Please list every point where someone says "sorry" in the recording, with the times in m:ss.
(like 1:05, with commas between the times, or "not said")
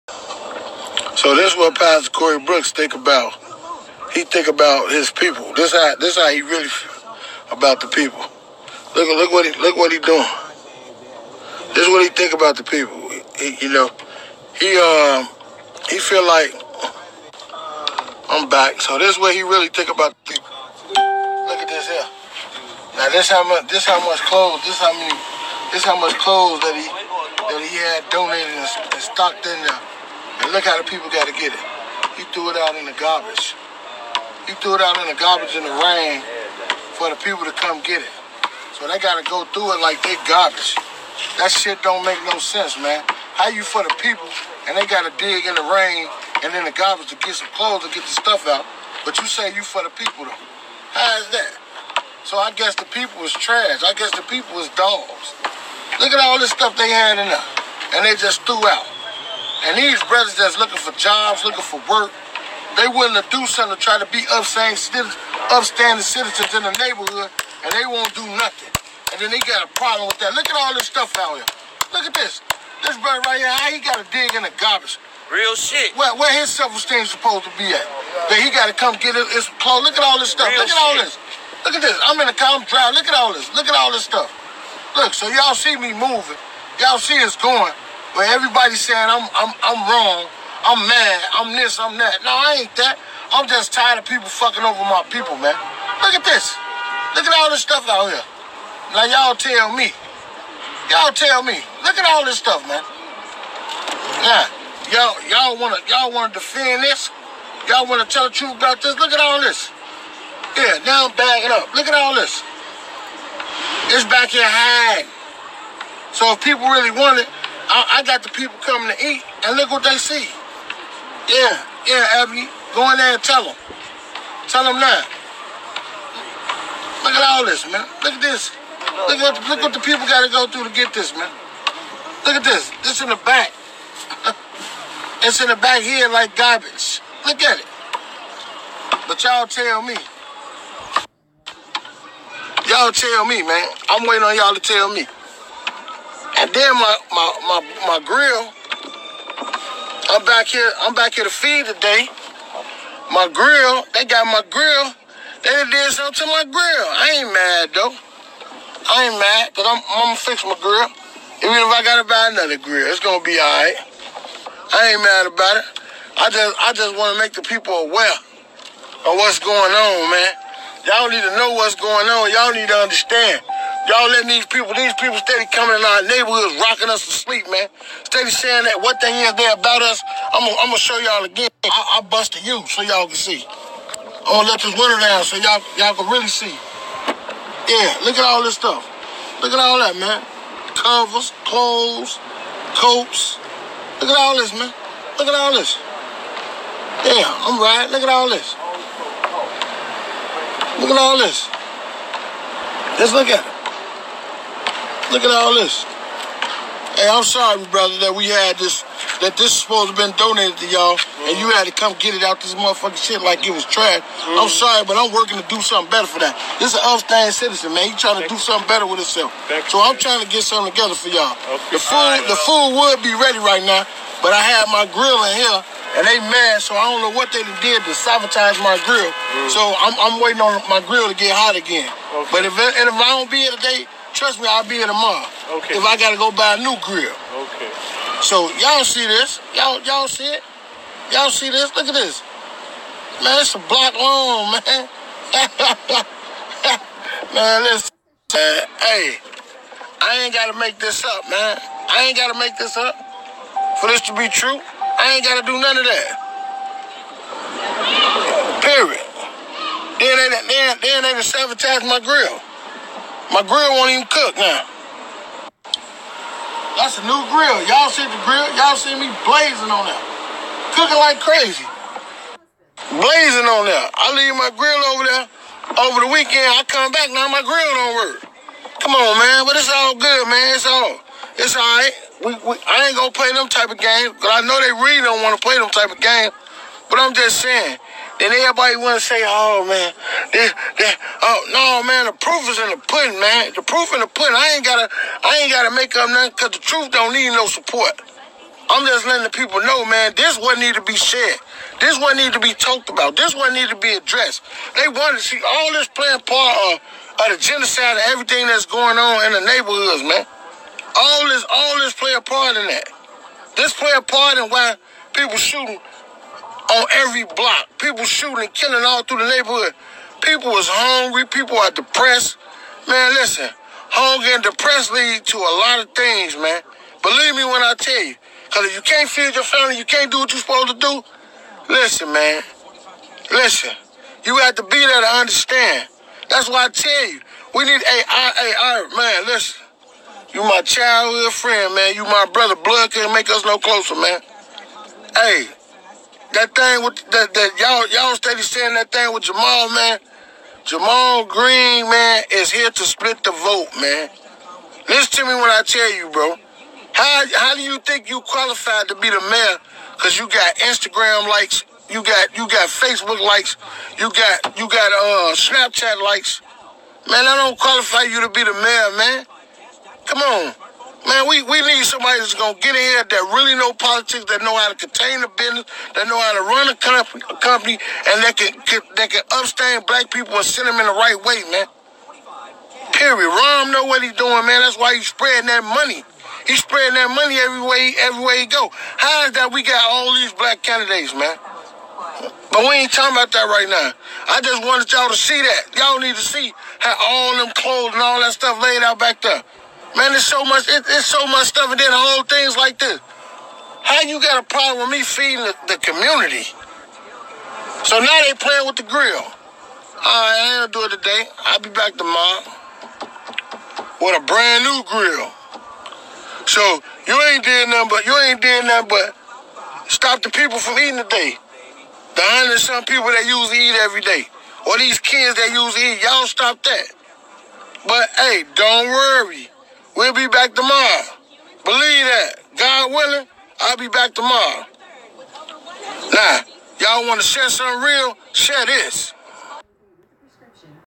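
3:27, 3:34.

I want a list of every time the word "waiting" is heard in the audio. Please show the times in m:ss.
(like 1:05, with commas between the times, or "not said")
2:24, 3:50.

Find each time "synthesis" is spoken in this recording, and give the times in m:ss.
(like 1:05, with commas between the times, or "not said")
not said.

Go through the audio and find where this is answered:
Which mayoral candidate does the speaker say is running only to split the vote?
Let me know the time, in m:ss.
5:50.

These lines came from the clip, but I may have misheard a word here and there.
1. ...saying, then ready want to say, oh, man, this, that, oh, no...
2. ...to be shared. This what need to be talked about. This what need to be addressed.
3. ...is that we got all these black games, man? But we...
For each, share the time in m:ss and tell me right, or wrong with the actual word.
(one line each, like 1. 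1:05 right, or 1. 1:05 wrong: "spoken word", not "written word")
1. 4:47 wrong: "everybody", not "ready"
2. 5:00 right
3. 6:29 wrong: "candidates", not "games".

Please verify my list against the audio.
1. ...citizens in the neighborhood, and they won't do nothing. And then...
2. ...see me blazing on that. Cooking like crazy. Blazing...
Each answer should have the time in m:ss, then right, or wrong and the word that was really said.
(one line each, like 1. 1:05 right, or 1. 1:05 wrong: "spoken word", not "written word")
1. 1:06 right
2. 4:28 right.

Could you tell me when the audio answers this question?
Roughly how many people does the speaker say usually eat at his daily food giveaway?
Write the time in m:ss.
7:02.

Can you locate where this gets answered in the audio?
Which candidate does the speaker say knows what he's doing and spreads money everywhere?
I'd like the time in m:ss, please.
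6:23.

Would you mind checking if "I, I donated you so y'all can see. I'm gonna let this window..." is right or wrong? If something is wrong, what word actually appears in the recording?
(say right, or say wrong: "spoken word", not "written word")
wrong: "busted", not "donated".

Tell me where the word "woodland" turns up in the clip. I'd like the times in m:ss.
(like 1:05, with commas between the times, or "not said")
not said.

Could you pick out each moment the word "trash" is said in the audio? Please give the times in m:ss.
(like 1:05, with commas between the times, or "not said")
0:53, 3:33.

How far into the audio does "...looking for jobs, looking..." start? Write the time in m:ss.
1:00.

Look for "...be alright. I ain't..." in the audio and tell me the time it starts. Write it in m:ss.
2:43.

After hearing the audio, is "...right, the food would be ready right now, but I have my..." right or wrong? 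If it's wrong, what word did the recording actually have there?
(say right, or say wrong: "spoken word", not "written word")
right.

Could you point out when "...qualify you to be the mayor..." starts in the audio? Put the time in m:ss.
6:07.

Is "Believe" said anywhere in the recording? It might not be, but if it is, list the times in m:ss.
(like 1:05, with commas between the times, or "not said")
5:27, 7:11.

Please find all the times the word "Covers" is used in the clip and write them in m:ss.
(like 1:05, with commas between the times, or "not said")
3:10.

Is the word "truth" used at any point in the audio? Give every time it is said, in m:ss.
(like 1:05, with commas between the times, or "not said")
1:48, 4:56.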